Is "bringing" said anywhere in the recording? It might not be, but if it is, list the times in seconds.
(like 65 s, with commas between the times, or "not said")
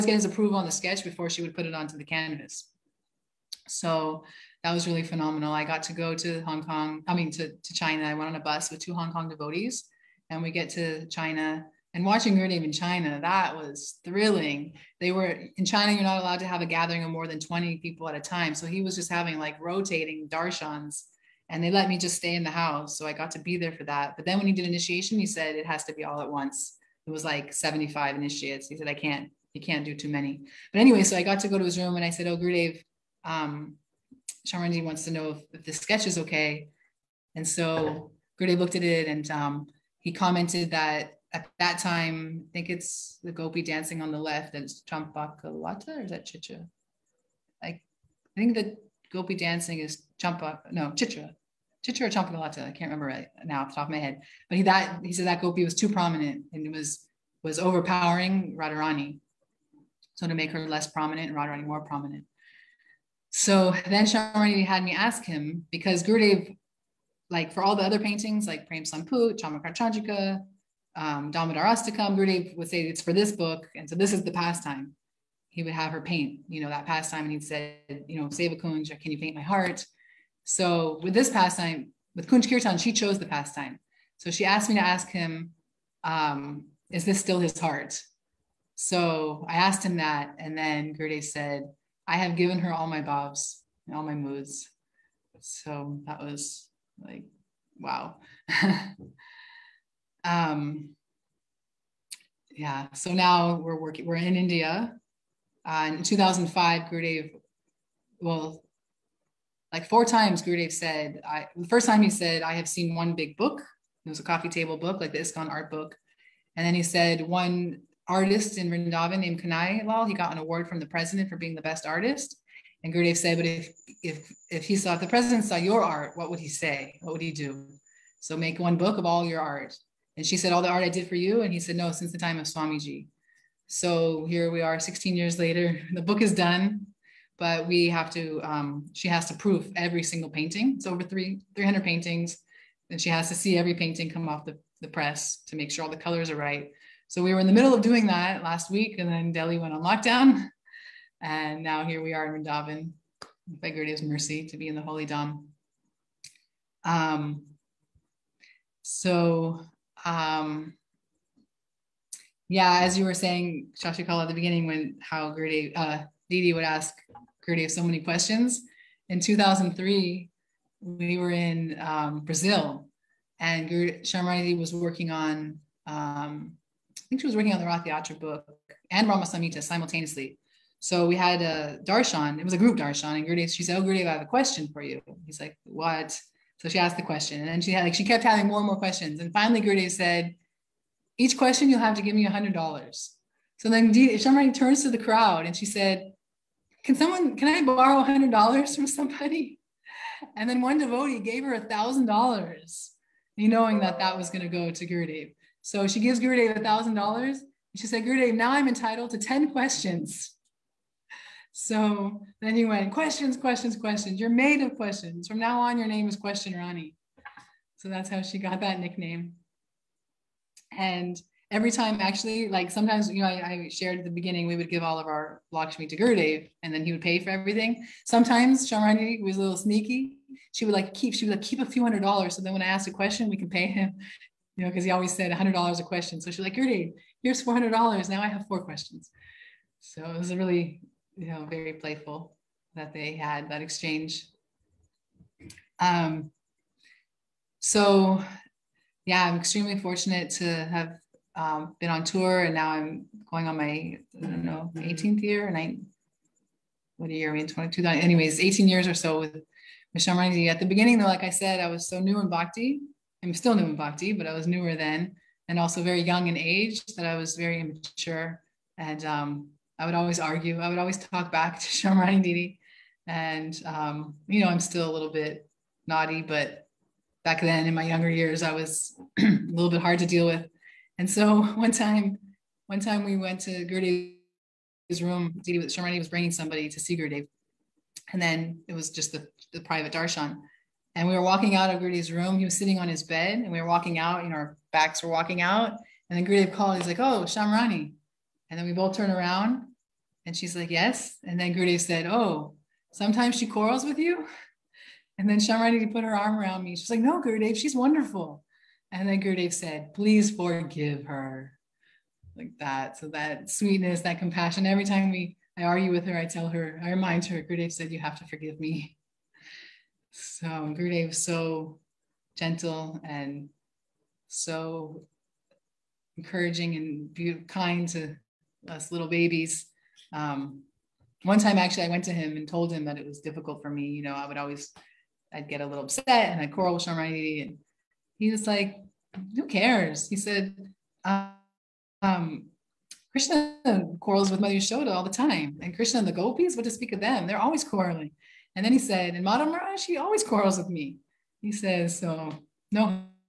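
286 s.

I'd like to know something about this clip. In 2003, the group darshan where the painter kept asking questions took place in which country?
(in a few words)
Brazil.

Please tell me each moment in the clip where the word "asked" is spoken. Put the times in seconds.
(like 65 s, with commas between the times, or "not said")
84 s, 89 s, 186 s, 232 s.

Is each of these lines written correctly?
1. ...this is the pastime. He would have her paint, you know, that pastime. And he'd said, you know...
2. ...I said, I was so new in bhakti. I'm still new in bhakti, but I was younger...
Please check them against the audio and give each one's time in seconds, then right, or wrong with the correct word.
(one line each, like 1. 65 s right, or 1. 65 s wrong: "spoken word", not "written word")
1. 73 s right
2. 261 s wrong: "newer", not "younger".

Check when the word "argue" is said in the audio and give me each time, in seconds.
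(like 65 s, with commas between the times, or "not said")
270 s, 315 s.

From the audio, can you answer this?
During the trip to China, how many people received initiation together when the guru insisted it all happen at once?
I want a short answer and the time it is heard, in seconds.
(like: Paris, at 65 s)
75, at 27 s.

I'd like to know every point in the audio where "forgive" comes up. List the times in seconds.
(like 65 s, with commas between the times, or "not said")
310 s, 318 s.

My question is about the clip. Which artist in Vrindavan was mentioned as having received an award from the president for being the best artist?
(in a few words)
Kanai Lal.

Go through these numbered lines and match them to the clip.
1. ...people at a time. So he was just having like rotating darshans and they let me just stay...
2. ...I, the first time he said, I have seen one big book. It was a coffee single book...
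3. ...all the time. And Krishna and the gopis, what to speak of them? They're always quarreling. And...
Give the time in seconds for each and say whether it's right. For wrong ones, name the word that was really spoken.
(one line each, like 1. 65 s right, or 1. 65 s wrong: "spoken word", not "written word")
1. 17 s right
2. 111 s wrong: "table", not "single"
3. 344 s right.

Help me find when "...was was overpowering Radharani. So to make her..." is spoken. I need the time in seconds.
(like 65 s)
56 s.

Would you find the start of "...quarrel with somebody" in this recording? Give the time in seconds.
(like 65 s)
336 s.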